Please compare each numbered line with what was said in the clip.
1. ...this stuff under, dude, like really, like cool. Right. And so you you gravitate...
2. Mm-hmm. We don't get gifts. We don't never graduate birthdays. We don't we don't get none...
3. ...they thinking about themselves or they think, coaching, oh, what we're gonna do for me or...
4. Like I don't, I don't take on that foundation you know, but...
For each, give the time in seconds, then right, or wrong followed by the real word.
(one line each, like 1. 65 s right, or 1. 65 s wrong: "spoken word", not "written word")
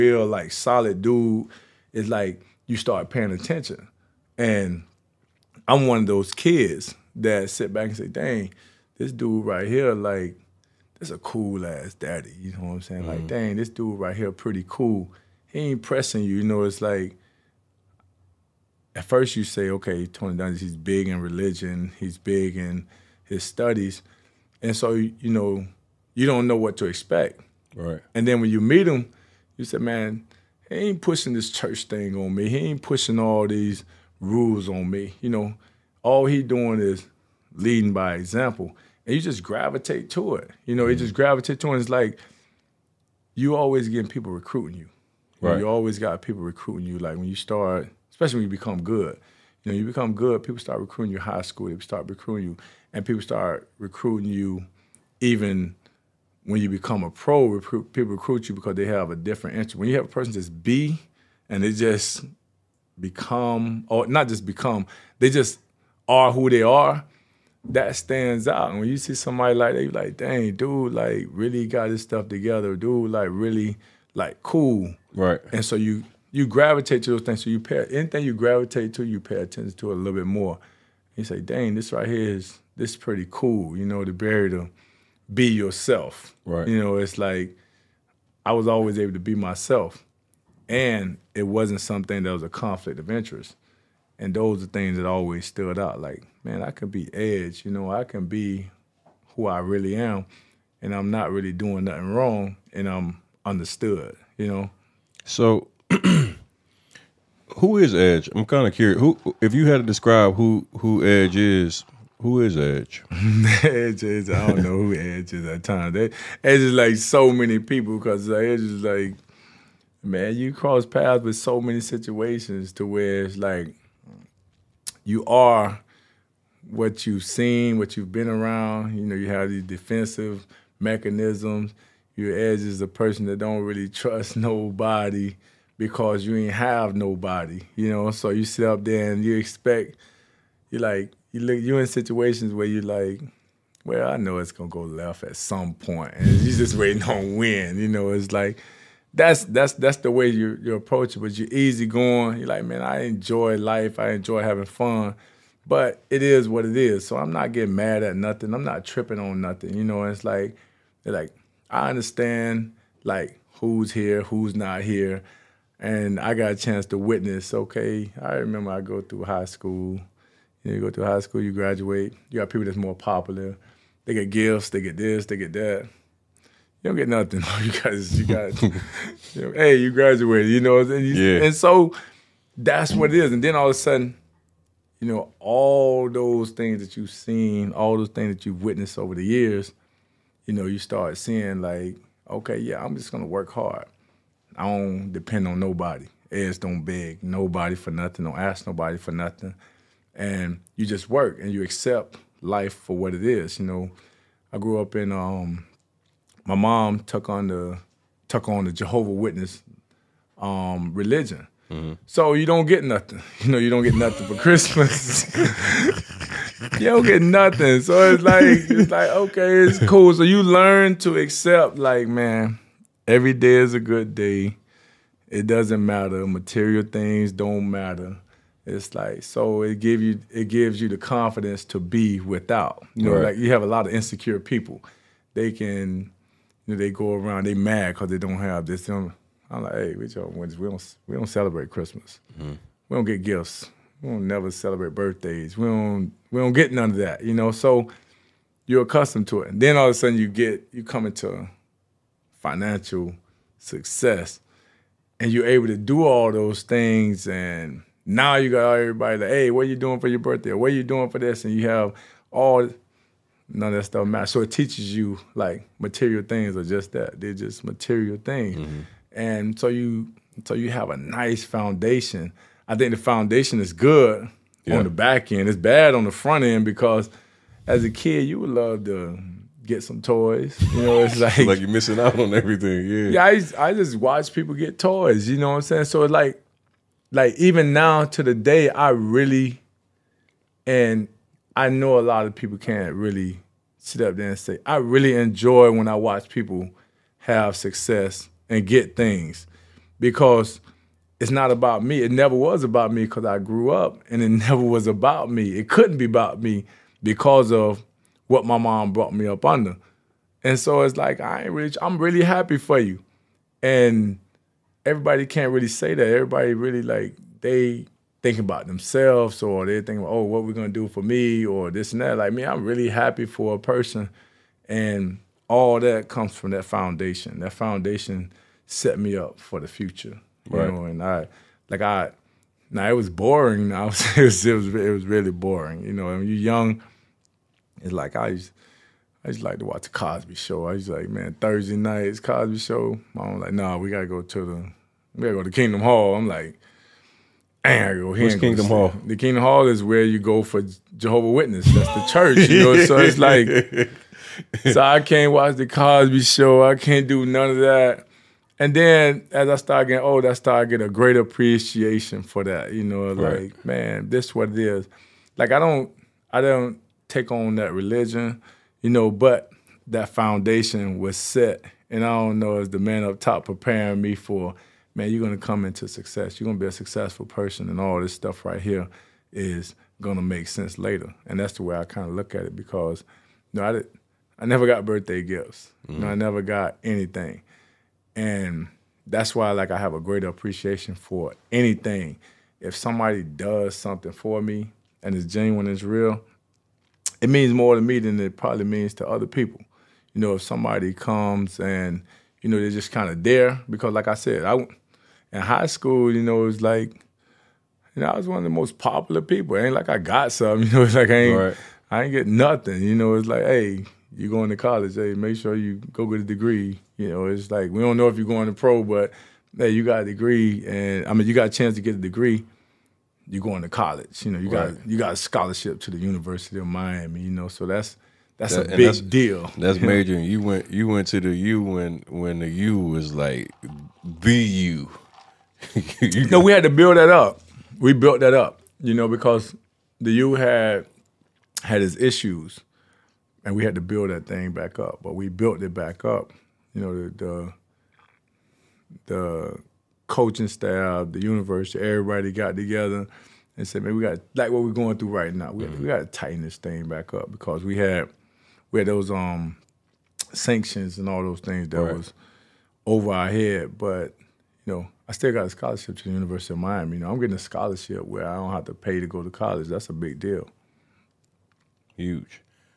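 1. 71 s wrong: "together", not "under"
2. 242 s wrong: "celebrate", not "graduate"
3. 317 s wrong: "thinking", not "coaching"
4. 365 s wrong: "religion", not "foundation".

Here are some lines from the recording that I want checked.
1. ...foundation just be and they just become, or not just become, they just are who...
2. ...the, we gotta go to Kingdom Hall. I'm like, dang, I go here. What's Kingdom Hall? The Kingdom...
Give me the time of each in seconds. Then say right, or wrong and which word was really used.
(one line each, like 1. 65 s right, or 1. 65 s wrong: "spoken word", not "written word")
1. 60 s wrong: "person", not "foundation"
2. 344 s right.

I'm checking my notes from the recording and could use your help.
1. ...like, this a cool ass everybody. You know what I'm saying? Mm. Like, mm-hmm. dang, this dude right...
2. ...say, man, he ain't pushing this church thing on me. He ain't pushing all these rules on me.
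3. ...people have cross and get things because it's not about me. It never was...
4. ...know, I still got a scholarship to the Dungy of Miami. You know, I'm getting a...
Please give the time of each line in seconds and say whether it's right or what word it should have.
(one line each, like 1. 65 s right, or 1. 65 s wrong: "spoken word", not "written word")
1. 9 s wrong: "daddy", not "everybody"
2. 29 s right
3. 296 s wrong: "success", not "cross"
4. 464 s wrong: "University", not "Dungy".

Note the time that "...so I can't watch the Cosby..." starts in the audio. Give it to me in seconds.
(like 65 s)
354 s.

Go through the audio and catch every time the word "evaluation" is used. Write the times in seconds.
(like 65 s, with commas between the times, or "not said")
not said.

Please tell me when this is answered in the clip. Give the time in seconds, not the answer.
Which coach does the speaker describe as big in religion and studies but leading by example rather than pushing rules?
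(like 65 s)
20 s.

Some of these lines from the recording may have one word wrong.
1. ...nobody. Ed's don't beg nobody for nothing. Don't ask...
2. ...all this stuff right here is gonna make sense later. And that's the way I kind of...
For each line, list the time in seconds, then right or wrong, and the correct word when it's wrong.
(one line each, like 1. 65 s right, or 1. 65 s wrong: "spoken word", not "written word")
1. 195 s right
2. 377 s right.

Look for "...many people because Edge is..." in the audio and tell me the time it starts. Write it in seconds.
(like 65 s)
117 s.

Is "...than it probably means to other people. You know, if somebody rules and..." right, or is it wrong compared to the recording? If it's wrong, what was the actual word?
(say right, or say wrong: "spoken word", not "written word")
wrong: "comes", not "rules".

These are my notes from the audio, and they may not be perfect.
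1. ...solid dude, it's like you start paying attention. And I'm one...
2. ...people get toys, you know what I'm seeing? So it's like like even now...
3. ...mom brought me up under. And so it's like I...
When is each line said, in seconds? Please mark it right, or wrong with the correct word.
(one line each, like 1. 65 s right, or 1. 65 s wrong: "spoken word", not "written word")
1. 0 s right
2. 284 s wrong: "saying", not "seeing"
3. 308 s right.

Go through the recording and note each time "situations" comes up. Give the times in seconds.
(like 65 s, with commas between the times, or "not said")
121 s, 141 s.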